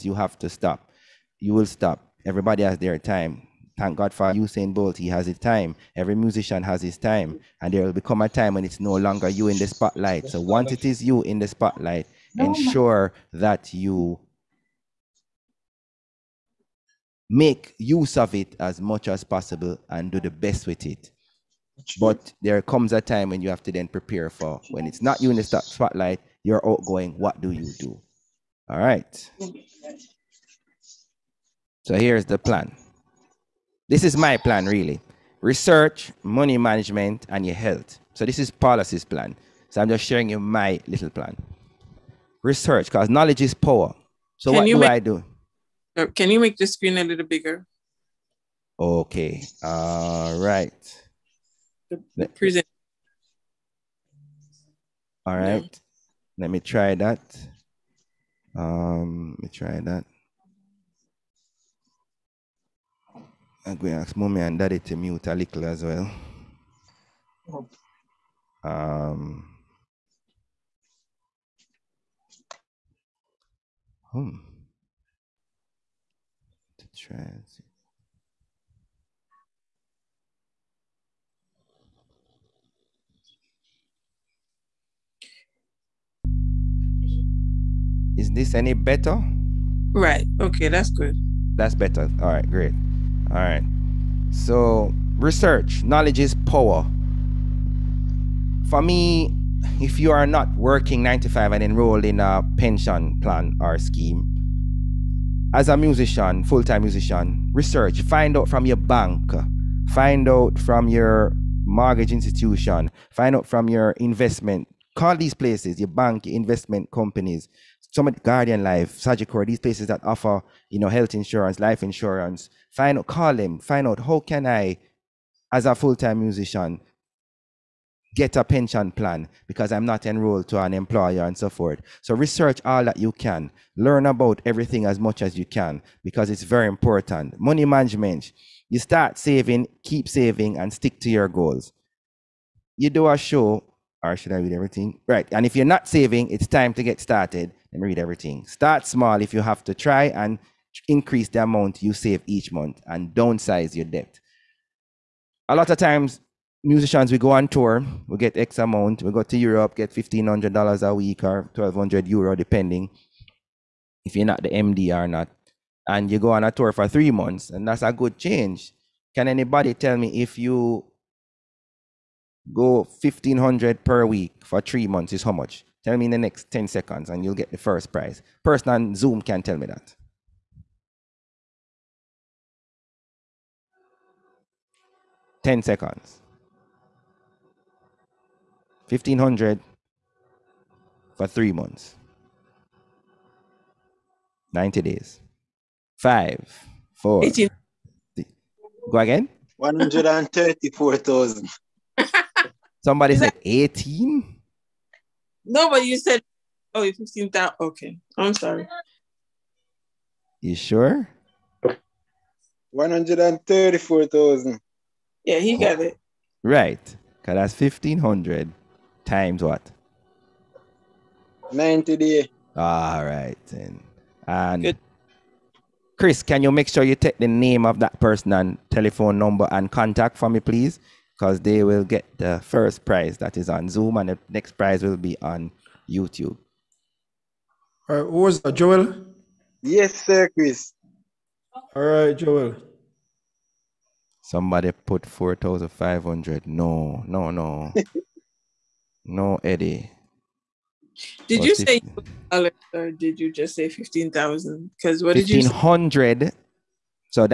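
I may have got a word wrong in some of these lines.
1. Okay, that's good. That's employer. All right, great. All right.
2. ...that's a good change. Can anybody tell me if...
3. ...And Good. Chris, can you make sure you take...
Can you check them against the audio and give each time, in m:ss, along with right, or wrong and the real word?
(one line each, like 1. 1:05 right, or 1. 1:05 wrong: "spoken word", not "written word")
1. 1:30 wrong: "better", not "employer"
2. 2:47 right
3. 3:44 right.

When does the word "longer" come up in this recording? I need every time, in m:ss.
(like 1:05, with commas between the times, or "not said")
0:08.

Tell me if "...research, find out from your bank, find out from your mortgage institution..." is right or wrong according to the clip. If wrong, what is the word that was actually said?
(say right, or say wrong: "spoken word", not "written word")
right.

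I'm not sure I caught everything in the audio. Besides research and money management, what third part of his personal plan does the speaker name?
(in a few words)
your health.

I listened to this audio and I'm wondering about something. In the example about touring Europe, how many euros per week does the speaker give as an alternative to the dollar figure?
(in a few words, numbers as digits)
1,200 euro.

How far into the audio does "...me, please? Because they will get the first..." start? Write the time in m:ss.
3:50.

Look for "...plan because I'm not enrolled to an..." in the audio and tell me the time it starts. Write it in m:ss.
2:08.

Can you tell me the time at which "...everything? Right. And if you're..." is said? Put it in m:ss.
2:24.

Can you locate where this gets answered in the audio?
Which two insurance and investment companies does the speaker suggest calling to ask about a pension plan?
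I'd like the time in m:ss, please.
1:58.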